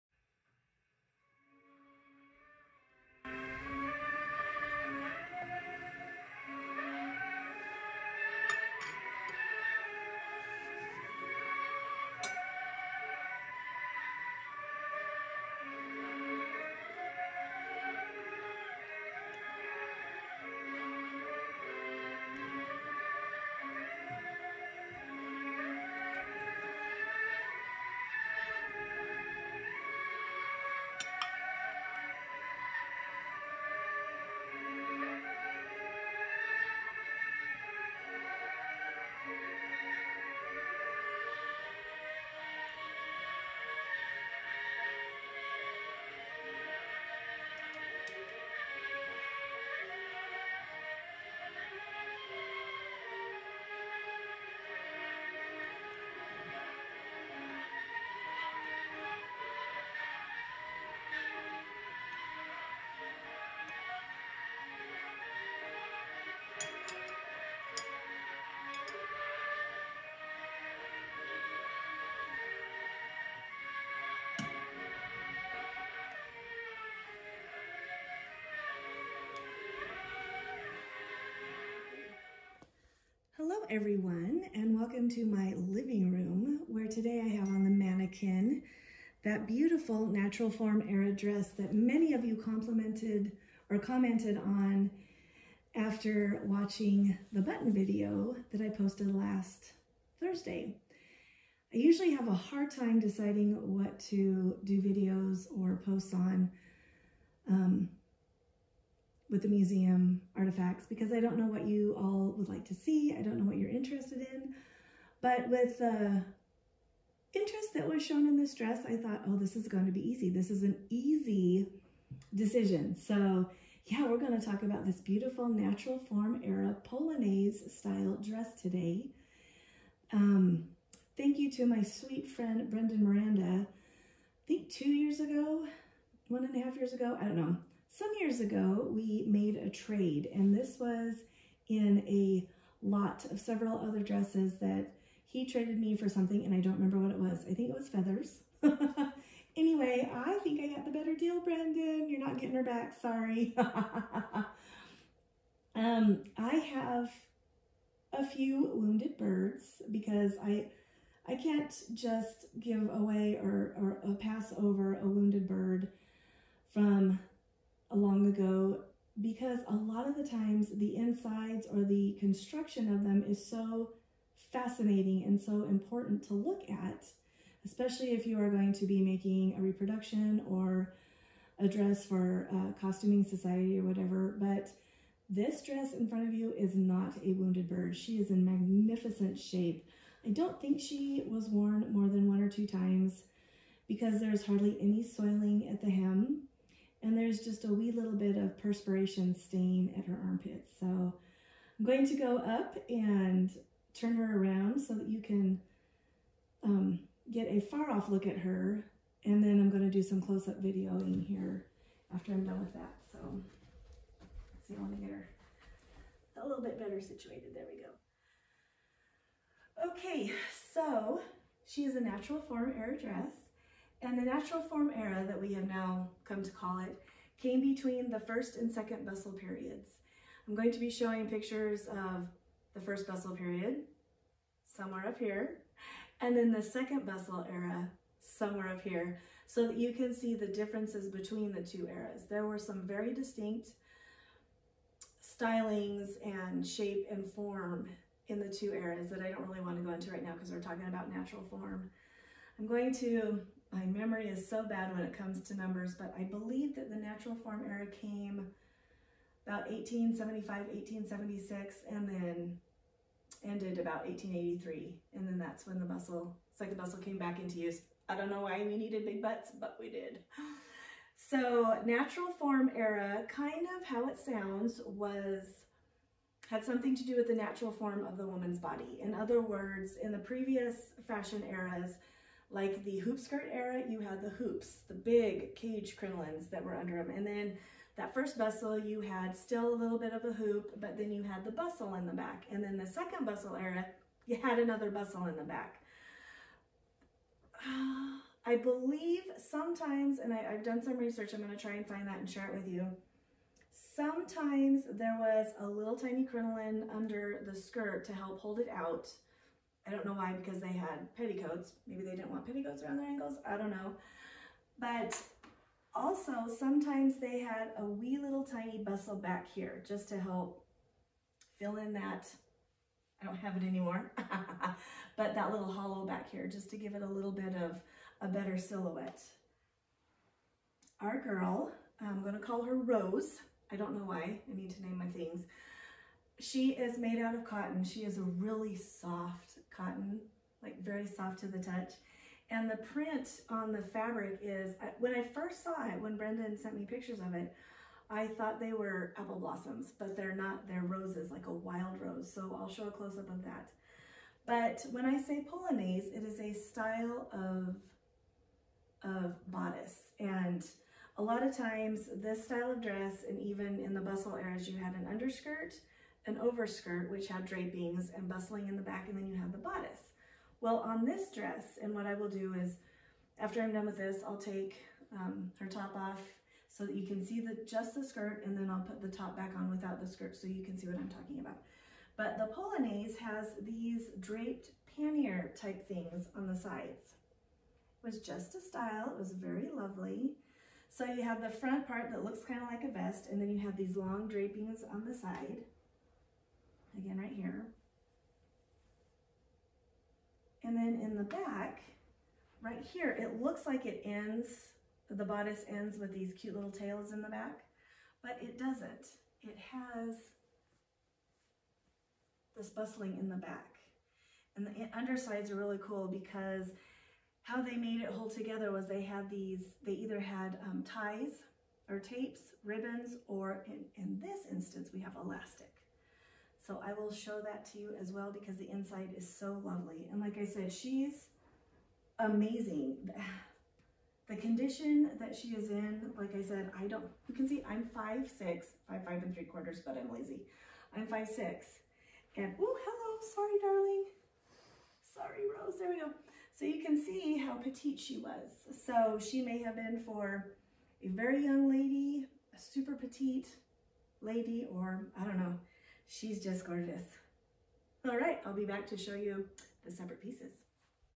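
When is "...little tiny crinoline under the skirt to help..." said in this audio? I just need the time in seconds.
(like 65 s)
305 s.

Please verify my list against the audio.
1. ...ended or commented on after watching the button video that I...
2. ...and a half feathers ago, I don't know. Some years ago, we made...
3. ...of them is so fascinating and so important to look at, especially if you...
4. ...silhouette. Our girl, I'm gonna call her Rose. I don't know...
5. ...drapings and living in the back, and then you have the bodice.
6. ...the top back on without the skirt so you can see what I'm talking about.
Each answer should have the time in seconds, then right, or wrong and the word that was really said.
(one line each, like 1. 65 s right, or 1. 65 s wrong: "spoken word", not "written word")
1. 92 s wrong: "complimented", not "ended"
2. 136 s wrong: "years", not "feathers"
3. 172 s right
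4. 328 s right
5. 367 s wrong: "bustling", not "living"
6. 379 s right.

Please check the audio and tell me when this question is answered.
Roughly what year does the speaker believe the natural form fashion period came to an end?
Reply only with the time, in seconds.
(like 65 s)
264 s.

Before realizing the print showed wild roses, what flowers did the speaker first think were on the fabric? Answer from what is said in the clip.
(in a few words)
Apple blossoms.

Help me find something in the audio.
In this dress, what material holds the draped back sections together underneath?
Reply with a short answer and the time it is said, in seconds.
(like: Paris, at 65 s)
Elastic, at 425 s.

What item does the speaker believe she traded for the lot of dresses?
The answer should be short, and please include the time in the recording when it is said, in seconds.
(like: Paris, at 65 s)
Feathers, at 147 s.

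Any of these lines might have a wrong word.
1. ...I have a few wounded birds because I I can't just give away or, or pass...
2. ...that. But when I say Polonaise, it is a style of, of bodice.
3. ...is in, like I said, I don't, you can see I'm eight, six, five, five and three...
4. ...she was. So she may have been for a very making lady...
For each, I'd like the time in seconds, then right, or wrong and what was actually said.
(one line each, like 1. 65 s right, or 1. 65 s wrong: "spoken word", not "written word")
1. 156 s right
2. 353 s right
3. 435 s wrong: "five", not "eight"
4. 447 s wrong: "young", not "making".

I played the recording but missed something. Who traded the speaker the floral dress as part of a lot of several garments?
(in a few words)
Brendan Miranda.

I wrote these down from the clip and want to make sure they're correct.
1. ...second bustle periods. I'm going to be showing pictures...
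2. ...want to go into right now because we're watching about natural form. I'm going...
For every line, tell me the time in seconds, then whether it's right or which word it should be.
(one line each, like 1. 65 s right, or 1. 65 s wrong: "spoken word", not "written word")
1. 228 s right
2. 249 s wrong: "talking", not "watching".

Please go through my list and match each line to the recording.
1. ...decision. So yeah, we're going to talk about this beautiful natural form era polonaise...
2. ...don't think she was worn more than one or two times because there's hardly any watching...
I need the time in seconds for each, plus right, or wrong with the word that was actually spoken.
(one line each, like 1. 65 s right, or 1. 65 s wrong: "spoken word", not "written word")
1. 122 s right
2. 190 s wrong: "soiling", not "watching".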